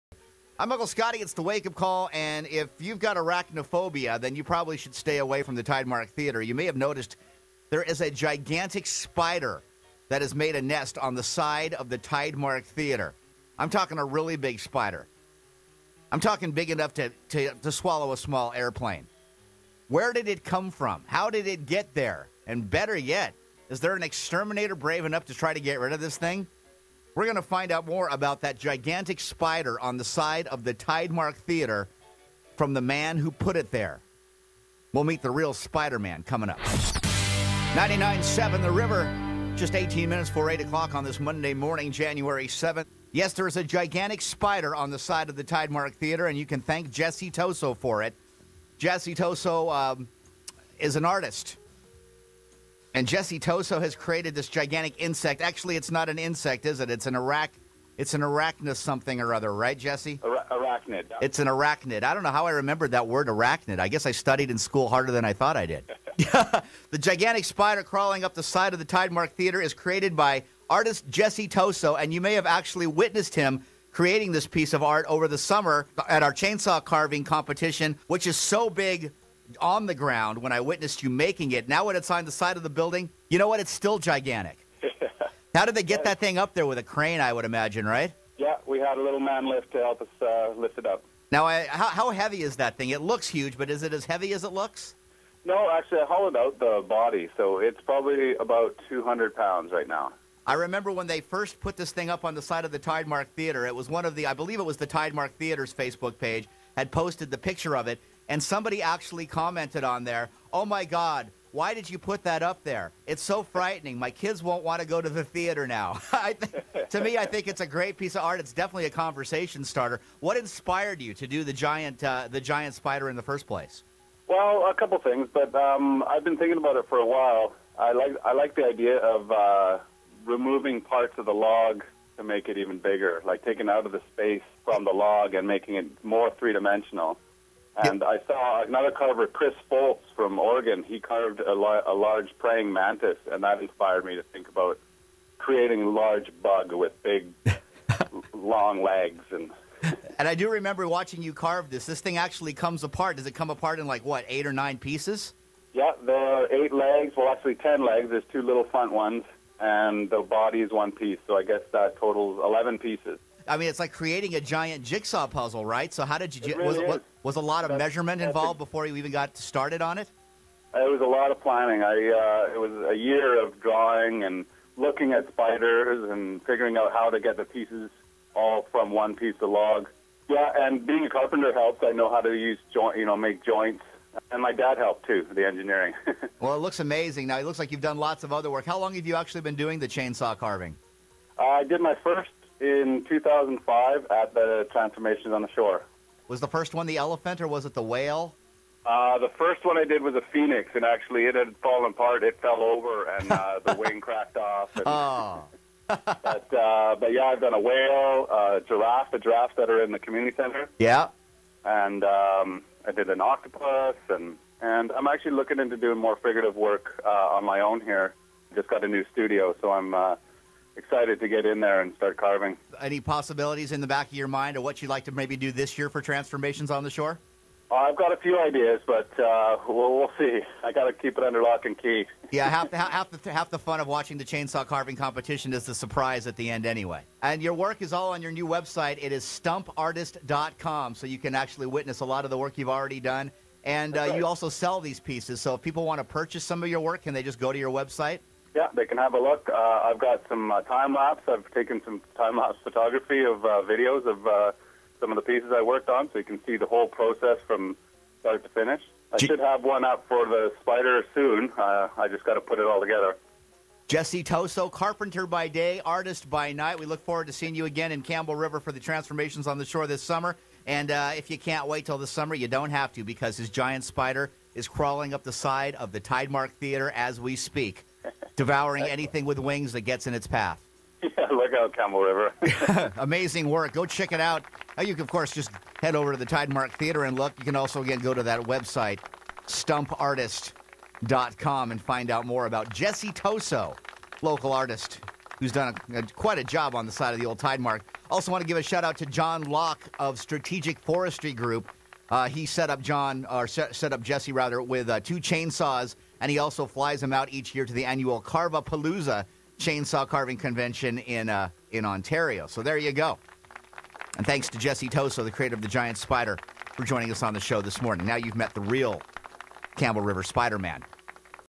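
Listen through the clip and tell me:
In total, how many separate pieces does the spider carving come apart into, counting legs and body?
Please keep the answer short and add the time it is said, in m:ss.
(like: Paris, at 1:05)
11, at 2:42.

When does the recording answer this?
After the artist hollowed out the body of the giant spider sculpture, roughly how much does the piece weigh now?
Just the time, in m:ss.
1:38.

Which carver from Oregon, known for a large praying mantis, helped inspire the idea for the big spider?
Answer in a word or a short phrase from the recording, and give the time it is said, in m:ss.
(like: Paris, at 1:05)
Chris Foltz, at 2:19.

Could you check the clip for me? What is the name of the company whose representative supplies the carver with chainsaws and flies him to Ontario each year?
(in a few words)
Strategic Forestry Group.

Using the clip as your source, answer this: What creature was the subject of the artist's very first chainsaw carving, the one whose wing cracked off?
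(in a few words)
Phoenix.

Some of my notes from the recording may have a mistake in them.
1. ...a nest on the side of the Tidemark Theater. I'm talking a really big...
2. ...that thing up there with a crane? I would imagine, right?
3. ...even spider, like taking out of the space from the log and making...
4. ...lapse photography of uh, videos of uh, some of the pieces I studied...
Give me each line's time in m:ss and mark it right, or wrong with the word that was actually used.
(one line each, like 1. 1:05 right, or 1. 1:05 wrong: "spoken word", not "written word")
1. 0:10 right
2. 1:26 right
3. 2:12 wrong: "bigger", not "spider"
4. 4:12 wrong: "worked", not "studied".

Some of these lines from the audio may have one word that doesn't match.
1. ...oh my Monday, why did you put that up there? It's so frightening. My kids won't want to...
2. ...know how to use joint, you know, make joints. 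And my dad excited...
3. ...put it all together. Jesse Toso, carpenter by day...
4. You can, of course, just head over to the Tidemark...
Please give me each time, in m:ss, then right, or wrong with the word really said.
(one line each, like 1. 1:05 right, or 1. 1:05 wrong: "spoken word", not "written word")
1. 1:50 wrong: "God", not "Monday"
2. 3:01 wrong: "helped", not "excited"
3. 4:22 right
4. 4:44 right.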